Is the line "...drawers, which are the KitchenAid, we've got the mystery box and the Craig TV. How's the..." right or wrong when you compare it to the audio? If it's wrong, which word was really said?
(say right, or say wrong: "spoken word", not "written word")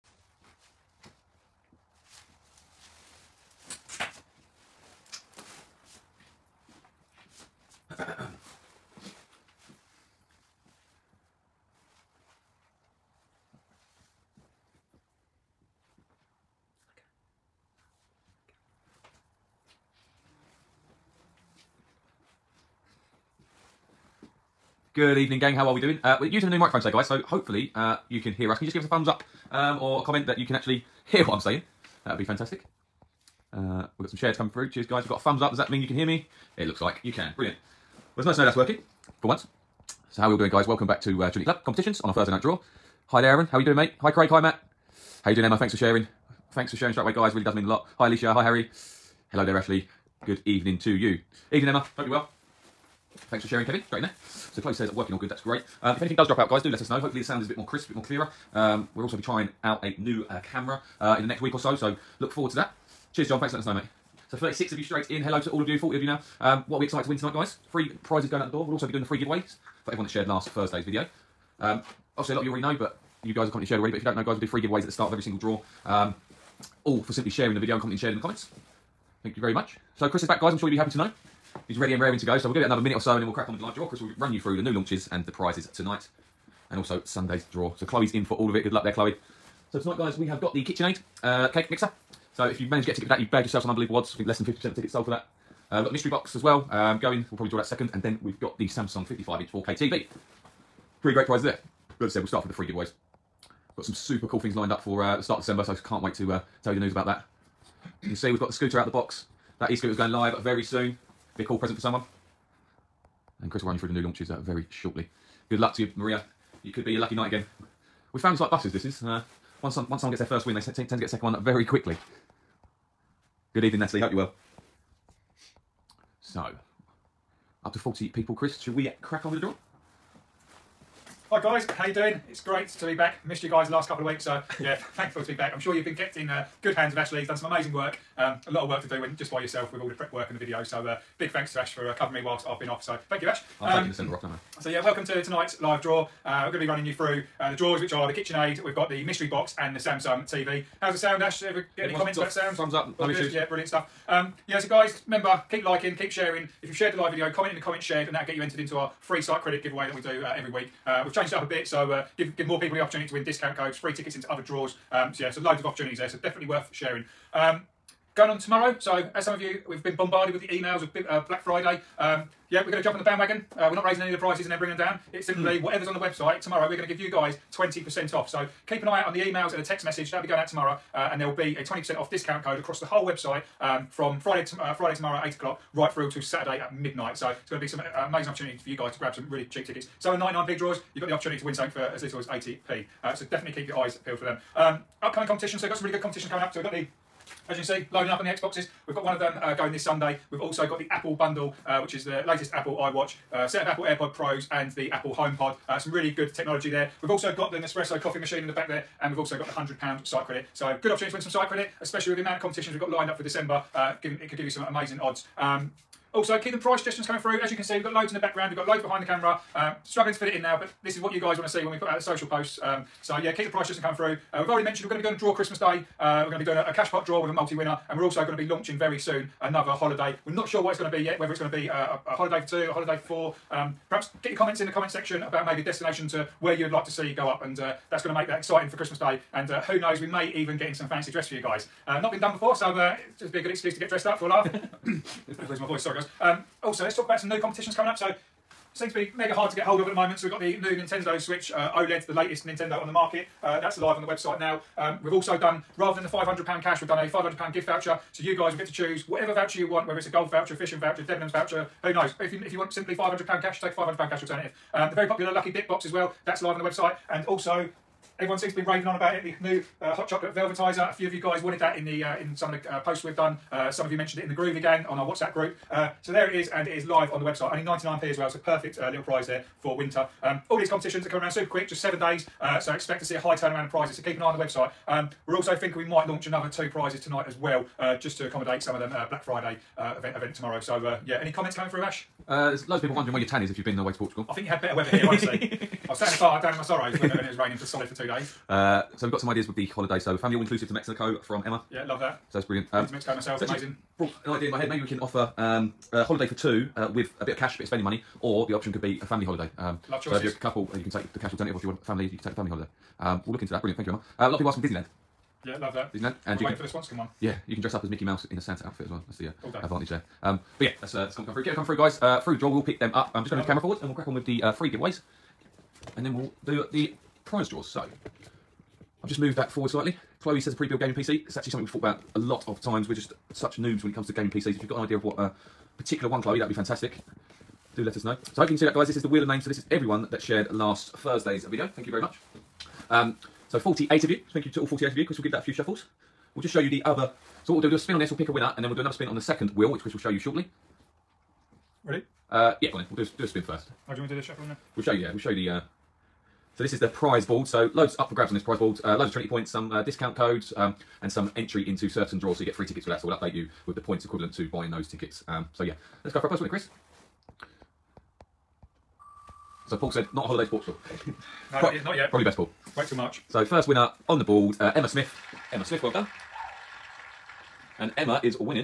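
wrong: "Samsung", not "Craig".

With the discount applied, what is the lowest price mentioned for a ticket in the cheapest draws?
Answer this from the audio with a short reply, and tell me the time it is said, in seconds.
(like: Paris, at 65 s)
80p, at 192 s.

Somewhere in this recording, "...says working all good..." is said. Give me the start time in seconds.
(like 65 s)
54 s.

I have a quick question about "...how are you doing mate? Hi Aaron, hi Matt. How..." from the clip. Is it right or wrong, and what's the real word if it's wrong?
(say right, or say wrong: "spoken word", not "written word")
wrong: "Craig", not "Aaron".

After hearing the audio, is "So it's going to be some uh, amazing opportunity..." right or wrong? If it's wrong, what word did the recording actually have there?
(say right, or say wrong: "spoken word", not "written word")
right.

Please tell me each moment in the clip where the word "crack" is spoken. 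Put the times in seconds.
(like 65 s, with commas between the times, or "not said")
83 s, 129 s, 323 s.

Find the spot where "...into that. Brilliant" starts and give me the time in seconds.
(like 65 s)
313 s.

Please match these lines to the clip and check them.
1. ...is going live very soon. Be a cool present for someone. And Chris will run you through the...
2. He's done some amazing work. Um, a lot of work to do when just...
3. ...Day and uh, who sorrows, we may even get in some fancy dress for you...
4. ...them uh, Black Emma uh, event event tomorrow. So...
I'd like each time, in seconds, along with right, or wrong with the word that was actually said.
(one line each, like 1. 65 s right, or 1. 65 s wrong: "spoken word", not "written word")
1. 109 s right
2. 137 s right
3. 238 s wrong: "knows", not "sorrows"
4. 288 s wrong: "Friday", not "Emma".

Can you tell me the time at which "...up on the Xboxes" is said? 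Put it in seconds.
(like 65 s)
198 s.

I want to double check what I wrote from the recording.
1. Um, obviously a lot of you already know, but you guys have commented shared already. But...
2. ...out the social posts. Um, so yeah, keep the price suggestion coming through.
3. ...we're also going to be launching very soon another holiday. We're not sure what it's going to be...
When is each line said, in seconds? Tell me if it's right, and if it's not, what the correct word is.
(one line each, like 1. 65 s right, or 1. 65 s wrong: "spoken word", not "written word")
1. 71 s right
2. 221 s right
3. 227 s right.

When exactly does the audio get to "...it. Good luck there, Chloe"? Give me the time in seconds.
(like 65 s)
88 s.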